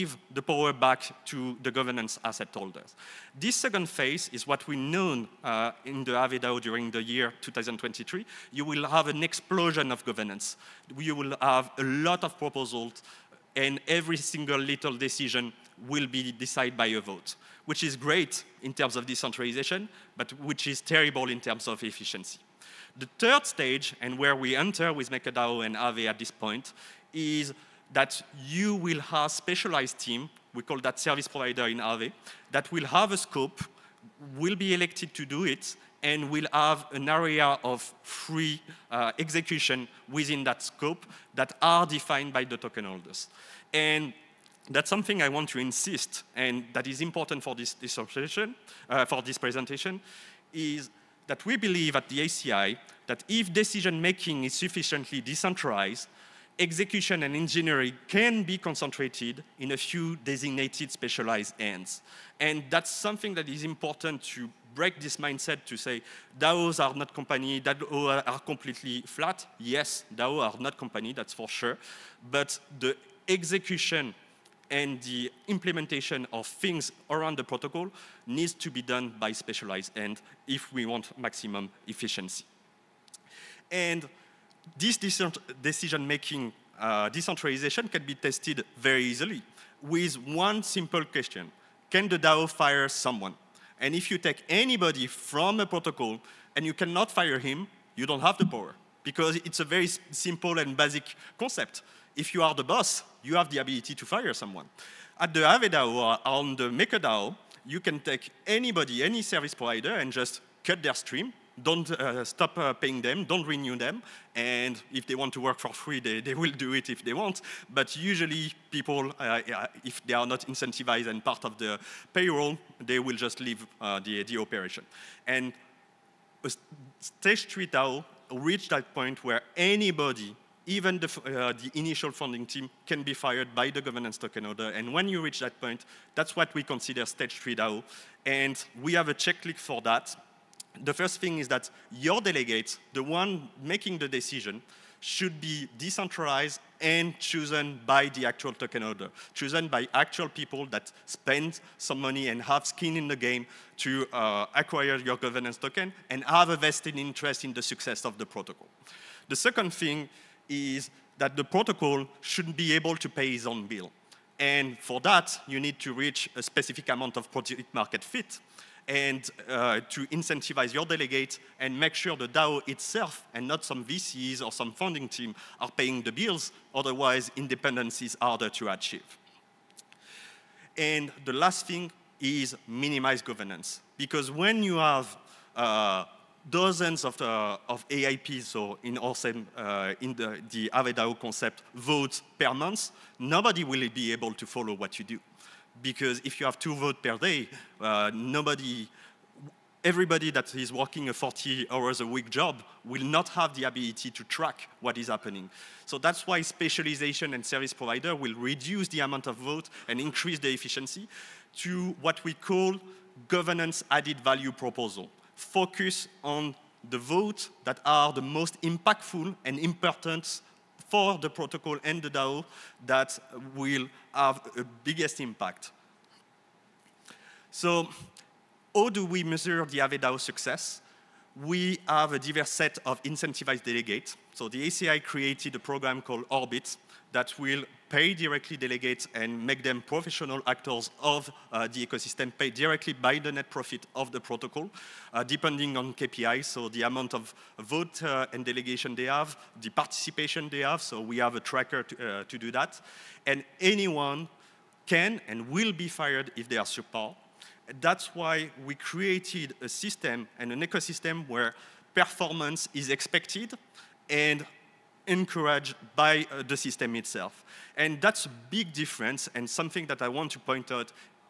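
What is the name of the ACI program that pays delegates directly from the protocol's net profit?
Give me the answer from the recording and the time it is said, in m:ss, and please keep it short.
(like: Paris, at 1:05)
Orbit, at 3:56.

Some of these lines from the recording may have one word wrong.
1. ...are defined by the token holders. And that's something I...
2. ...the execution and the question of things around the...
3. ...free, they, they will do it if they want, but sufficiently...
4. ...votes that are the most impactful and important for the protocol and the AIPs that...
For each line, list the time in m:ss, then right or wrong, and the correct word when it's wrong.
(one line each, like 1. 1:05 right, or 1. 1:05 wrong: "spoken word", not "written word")
1. 0:41 right
2. 1:12 wrong: "implementation", not "question"
3. 1:55 wrong: "usually", not "sufficiently"
4. 3:36 wrong: "DAO", not "AIPs".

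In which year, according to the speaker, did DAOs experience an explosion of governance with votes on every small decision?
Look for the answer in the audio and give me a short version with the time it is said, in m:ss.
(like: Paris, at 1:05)
2023, at 0:07.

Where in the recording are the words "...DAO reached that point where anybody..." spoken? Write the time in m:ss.
2:07.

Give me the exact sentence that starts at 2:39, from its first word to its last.
The second thing is that the protocol should be able to pay its own bill.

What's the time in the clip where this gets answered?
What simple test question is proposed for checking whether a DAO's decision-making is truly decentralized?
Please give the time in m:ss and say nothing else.
1:31.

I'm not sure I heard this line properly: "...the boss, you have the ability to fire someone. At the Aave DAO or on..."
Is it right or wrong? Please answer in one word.
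right.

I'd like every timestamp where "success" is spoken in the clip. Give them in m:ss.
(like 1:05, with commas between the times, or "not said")
2:37, 3:50.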